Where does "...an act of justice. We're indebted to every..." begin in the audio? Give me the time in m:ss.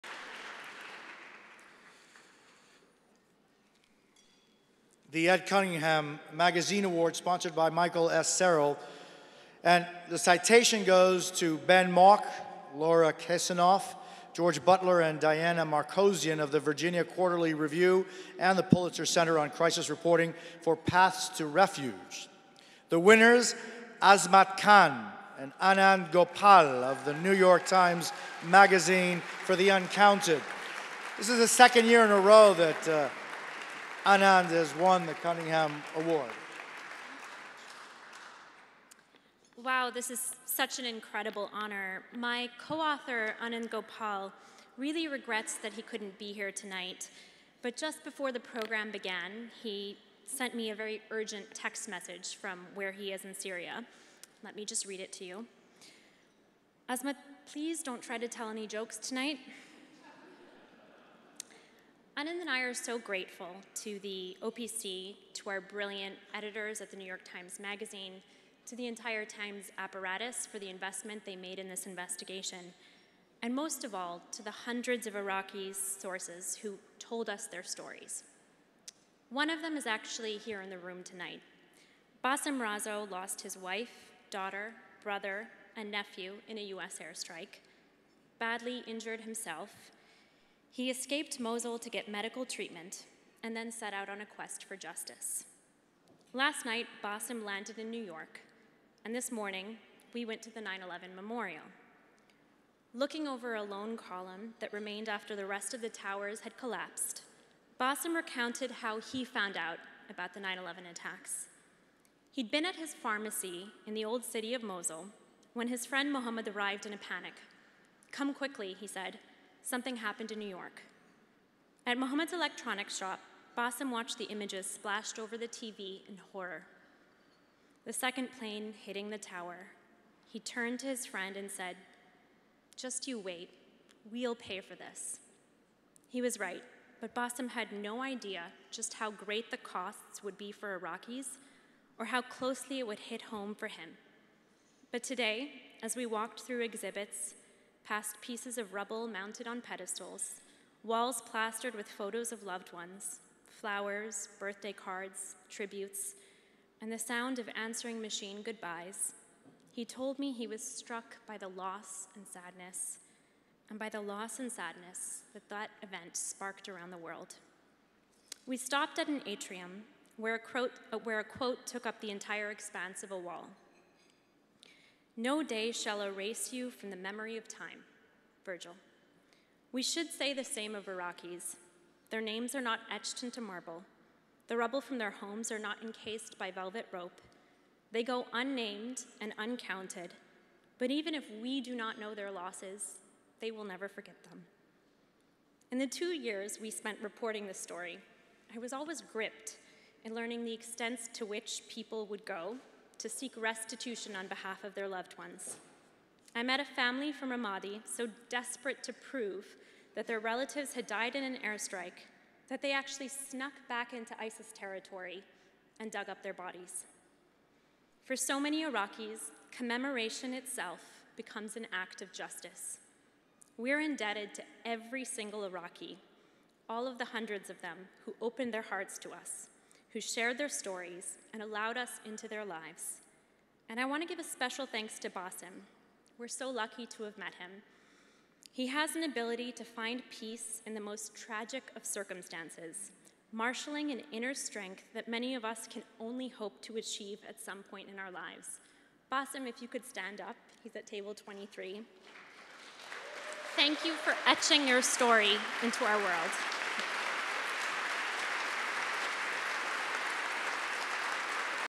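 3:41.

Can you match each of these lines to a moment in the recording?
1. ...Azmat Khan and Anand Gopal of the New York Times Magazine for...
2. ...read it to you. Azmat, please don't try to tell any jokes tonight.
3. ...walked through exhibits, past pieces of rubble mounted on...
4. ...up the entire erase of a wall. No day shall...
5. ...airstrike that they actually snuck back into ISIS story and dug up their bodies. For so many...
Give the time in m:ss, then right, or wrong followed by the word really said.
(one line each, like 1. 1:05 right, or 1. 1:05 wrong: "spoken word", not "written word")
1. 0:24 right
2. 0:54 right
3. 2:26 right
4. 2:51 wrong: "expanse", not "erase"
5. 3:31 wrong: "territory", not "story".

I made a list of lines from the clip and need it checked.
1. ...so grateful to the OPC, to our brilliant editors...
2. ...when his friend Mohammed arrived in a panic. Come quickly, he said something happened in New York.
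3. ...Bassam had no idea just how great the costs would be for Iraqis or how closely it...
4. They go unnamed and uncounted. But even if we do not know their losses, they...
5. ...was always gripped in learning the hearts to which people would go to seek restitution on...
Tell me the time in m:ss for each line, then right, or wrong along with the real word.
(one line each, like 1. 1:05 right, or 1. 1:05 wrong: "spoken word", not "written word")
1. 1:02 right
2. 1:55 right
3. 2:17 right
4. 3:07 right
5. 3:18 wrong: "extents", not "hearts".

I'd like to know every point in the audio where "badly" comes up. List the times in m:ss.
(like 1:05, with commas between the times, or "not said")
1:28.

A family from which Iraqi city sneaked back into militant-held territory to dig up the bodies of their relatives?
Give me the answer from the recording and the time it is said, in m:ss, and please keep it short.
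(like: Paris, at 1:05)
Ramadi, at 3:27.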